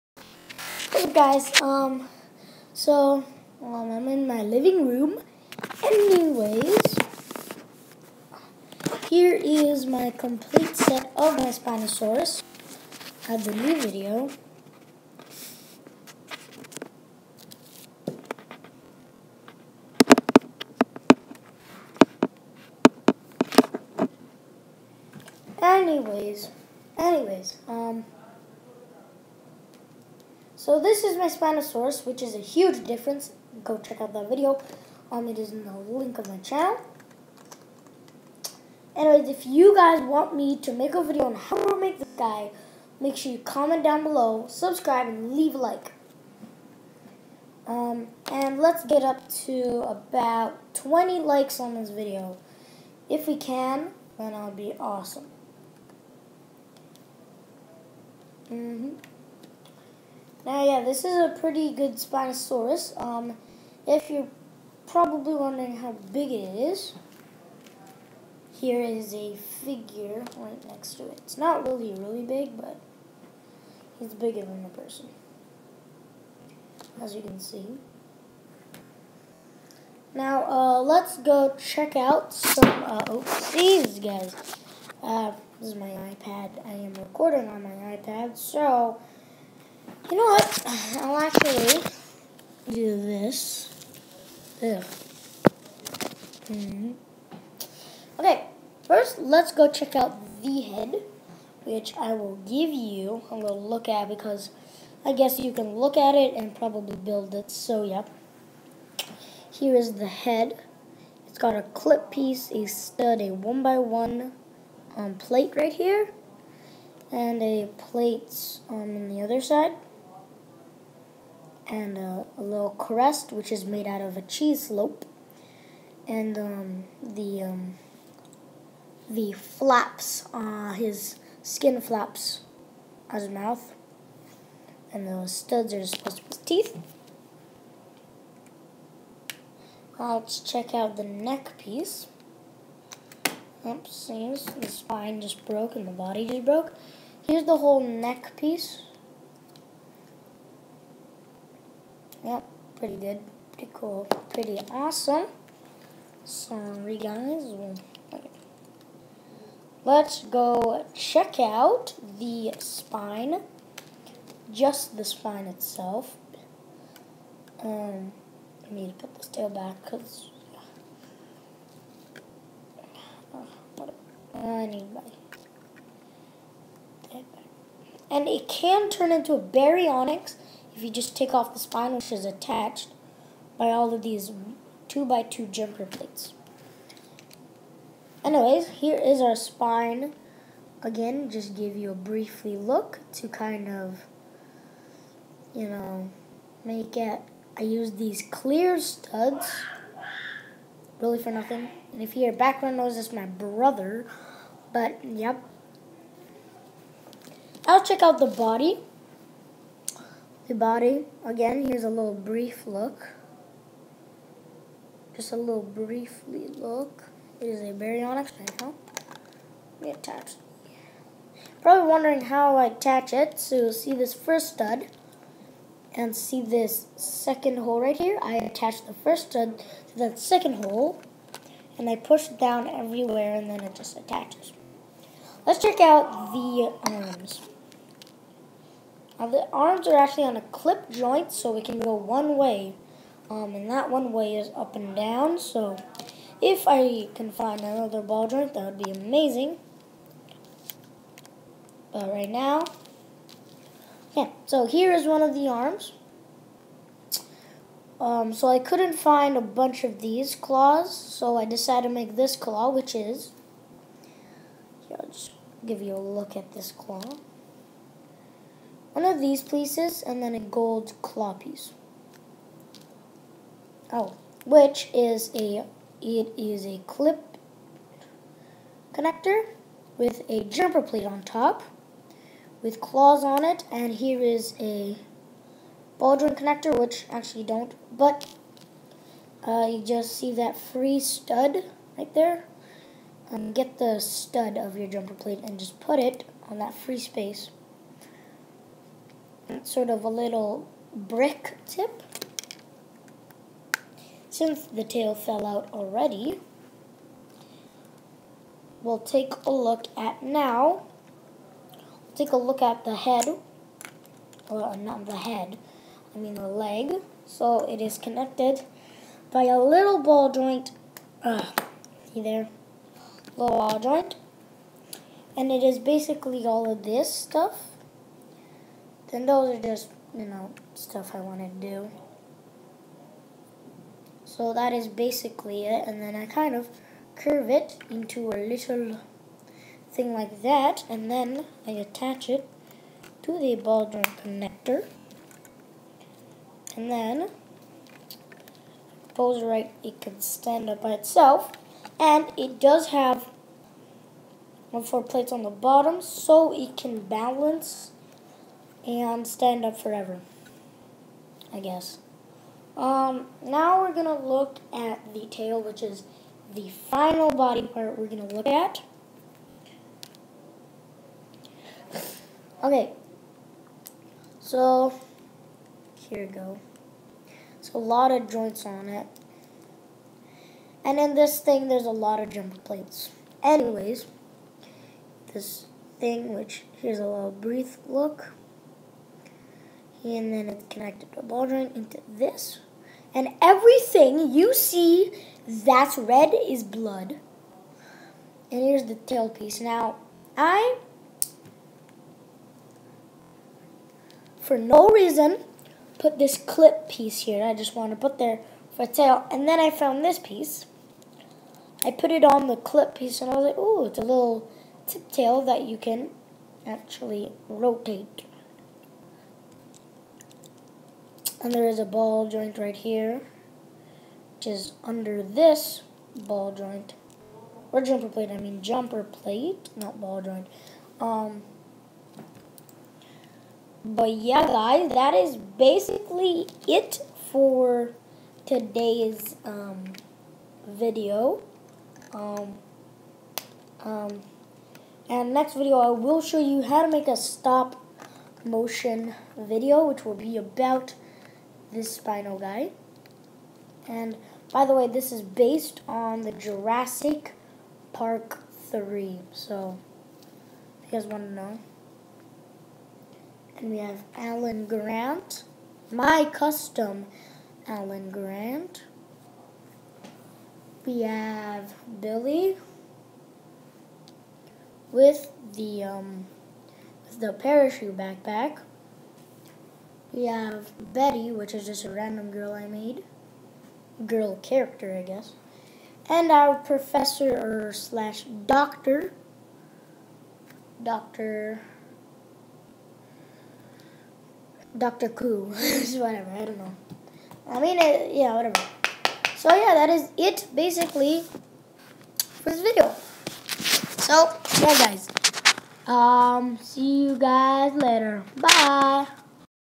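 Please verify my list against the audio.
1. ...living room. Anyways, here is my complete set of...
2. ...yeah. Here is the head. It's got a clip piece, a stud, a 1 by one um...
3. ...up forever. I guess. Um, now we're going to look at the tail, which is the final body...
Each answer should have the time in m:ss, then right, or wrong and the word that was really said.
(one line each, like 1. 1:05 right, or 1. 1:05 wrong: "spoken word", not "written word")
1. 0:04 right
2. 1:47 right
3. 5:59 right.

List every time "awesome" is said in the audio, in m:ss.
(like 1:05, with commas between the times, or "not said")
0:54, 2:34.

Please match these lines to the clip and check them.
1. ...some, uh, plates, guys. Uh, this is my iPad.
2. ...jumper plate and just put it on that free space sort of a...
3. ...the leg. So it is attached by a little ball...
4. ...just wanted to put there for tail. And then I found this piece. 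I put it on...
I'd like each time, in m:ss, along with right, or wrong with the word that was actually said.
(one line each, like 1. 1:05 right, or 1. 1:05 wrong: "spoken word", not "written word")
1. 1:22 wrong: "oopsies", not "plates"
2. 4:54 right
3. 5:16 wrong: "connected", not "attached"
4. 6:47 right.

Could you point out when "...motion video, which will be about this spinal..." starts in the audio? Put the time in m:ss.
7:28.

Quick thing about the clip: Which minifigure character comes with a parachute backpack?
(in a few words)
Billy.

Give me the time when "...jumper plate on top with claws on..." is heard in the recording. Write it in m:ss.
4:40.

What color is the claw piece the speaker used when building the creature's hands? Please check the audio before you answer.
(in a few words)
gold.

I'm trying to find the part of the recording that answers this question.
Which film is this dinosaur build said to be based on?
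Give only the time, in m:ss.
7:36.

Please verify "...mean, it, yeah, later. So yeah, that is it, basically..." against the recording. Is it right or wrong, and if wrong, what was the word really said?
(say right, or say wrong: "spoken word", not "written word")
wrong: "whatever", not "later".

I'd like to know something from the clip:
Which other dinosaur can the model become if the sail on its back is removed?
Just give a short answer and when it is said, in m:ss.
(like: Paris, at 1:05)
Baryonyx, at 2:59.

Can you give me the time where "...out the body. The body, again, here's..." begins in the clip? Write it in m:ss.
3:28.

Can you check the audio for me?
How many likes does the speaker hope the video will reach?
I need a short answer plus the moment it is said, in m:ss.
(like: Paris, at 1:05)
20, at 0:50.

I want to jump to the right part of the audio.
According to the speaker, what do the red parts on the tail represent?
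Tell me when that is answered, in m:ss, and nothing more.
6:36.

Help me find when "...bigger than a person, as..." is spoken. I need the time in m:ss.
1:14.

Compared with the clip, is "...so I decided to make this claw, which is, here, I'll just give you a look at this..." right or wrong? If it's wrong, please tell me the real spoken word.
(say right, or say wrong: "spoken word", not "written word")
right.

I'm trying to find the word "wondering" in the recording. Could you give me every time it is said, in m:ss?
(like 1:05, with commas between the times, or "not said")
1:05, 3:41.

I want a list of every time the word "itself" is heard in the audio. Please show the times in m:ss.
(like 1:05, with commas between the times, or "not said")
2:45, 5:50.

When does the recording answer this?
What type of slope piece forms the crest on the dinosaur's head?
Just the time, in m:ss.
2:04.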